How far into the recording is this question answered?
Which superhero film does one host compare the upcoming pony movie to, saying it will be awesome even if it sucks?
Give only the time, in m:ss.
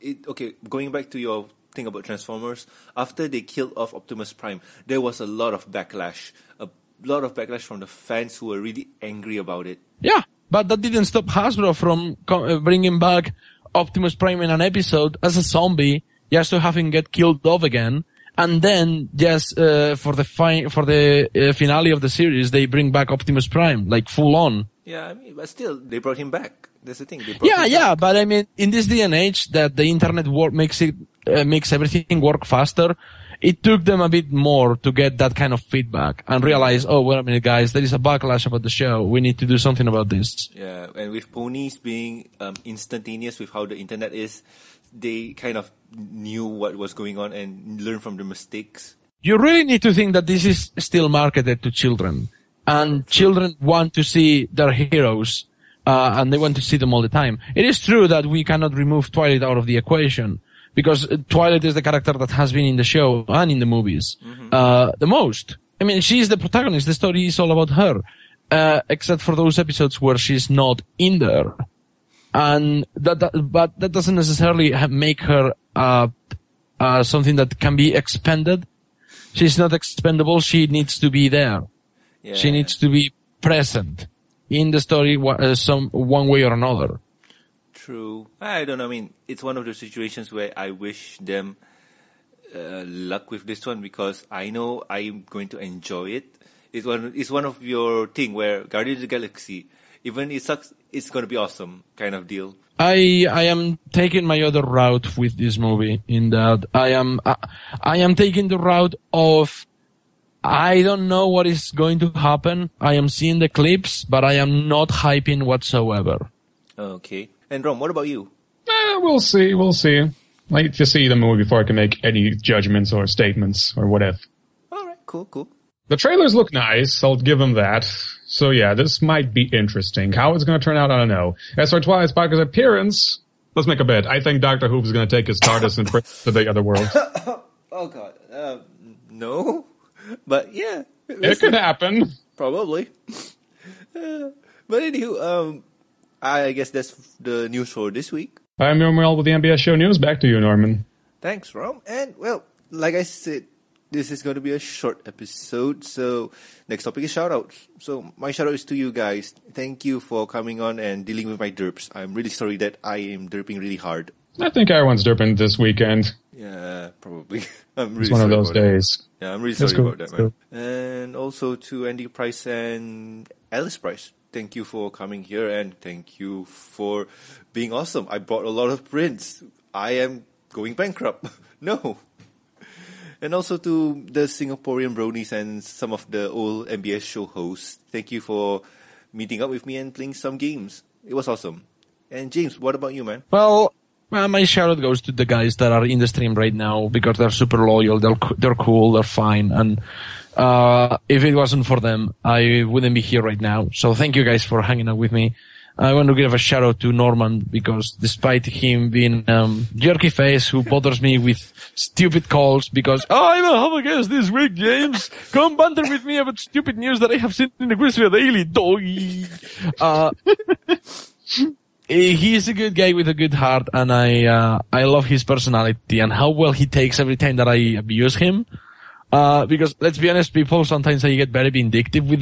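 1:38.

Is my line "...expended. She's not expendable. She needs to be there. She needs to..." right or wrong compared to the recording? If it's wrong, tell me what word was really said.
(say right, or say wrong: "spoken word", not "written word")
right.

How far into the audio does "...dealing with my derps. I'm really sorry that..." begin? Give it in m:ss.
2:41.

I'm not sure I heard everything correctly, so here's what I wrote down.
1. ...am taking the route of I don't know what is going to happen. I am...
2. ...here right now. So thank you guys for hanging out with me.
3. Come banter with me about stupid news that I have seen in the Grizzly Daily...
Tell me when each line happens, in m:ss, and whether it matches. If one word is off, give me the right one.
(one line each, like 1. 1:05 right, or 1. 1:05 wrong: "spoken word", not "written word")
1. 1:47 right
2. 3:23 right
3. 3:35 right.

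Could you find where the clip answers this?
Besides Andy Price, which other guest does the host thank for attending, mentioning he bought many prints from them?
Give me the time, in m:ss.
2:53.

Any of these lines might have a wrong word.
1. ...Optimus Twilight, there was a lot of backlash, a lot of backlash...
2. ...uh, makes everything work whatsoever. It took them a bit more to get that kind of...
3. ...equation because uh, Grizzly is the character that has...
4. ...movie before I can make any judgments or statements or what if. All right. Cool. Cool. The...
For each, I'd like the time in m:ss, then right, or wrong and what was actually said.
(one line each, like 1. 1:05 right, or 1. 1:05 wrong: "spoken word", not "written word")
1. 0:03 wrong: "Prime", not "Twilight"
2. 0:31 wrong: "faster", not "whatsoever"
3. 0:59 wrong: "Twilight", not "Grizzly"
4. 2:01 right.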